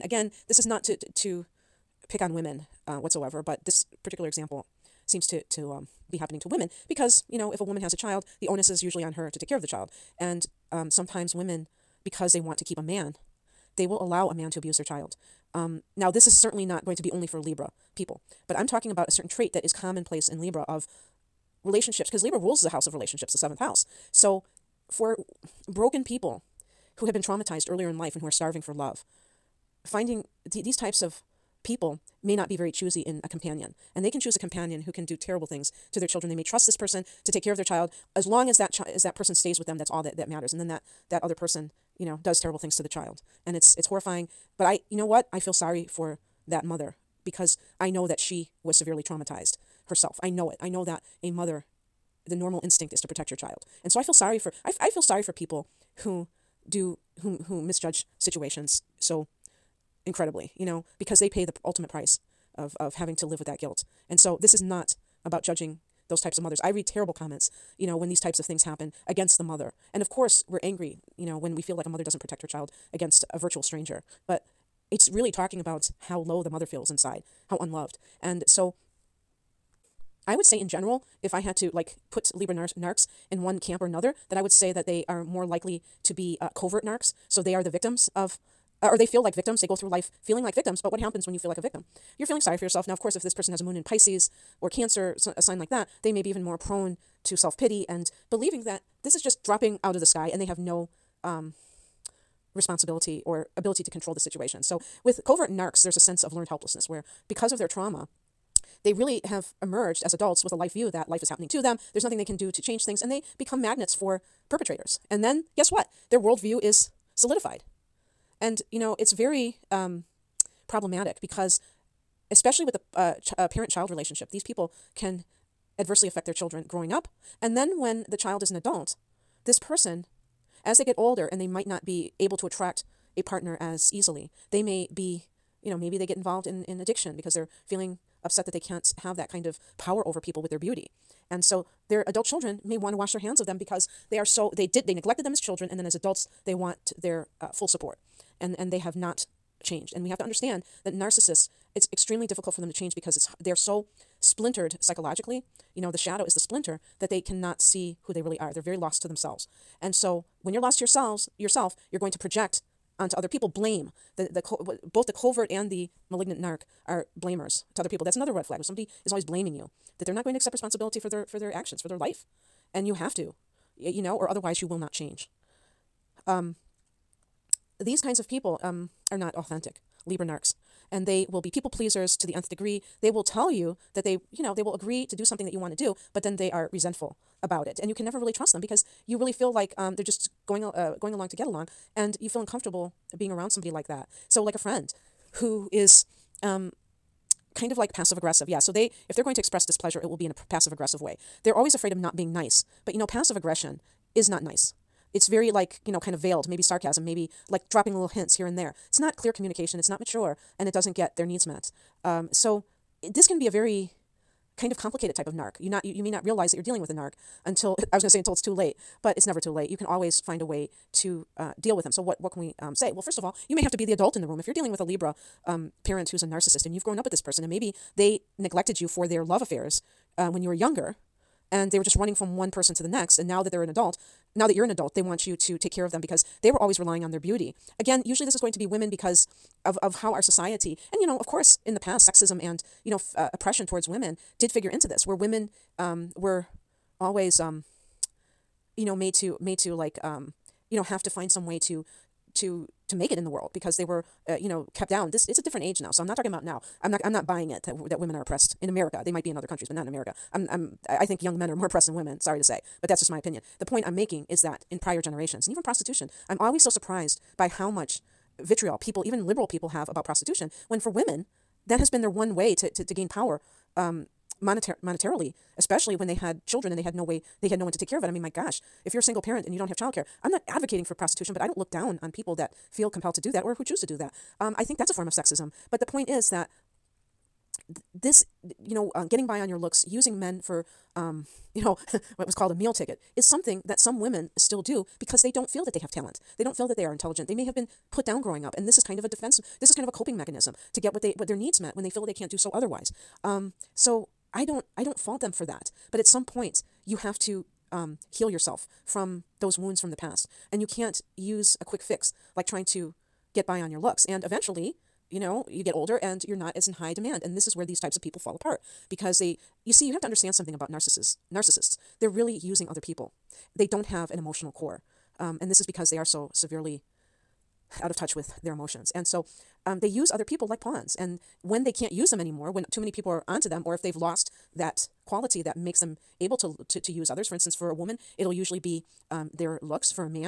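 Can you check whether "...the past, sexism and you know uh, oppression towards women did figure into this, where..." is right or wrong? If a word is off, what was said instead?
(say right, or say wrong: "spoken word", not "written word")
right.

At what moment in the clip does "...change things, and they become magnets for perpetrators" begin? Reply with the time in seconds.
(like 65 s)
112 s.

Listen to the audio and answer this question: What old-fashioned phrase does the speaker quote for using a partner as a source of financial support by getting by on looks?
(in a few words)
meal ticket.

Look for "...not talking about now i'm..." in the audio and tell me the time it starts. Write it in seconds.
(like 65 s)
256 s.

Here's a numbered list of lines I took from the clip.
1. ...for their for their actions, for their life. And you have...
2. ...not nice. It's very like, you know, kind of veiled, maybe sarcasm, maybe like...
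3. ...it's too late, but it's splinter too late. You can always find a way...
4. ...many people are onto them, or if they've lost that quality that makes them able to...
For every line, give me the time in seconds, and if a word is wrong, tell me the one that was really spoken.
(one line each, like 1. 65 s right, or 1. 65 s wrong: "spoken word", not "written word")
1. 170 s right
2. 204 s right
3. 218 s wrong: "never", not "splinter"
4. 332 s right.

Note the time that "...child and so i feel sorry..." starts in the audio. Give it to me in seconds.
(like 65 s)
53 s.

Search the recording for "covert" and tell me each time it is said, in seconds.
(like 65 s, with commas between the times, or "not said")
86 s, 105 s, 165 s.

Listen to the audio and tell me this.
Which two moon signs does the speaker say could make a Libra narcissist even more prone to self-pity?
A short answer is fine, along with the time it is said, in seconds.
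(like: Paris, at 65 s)
Pisces or Cancer, at 93 s.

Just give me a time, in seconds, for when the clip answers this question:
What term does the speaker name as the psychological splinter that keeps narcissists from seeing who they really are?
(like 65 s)
155 s.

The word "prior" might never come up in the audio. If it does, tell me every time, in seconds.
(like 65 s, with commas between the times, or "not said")
264 s.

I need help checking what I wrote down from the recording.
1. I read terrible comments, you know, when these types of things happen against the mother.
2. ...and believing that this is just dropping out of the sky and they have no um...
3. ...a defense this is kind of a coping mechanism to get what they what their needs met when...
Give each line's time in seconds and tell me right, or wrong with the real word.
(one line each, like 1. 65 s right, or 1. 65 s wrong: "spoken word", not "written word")
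1. 66 s right
2. 97 s right
3. 299 s right.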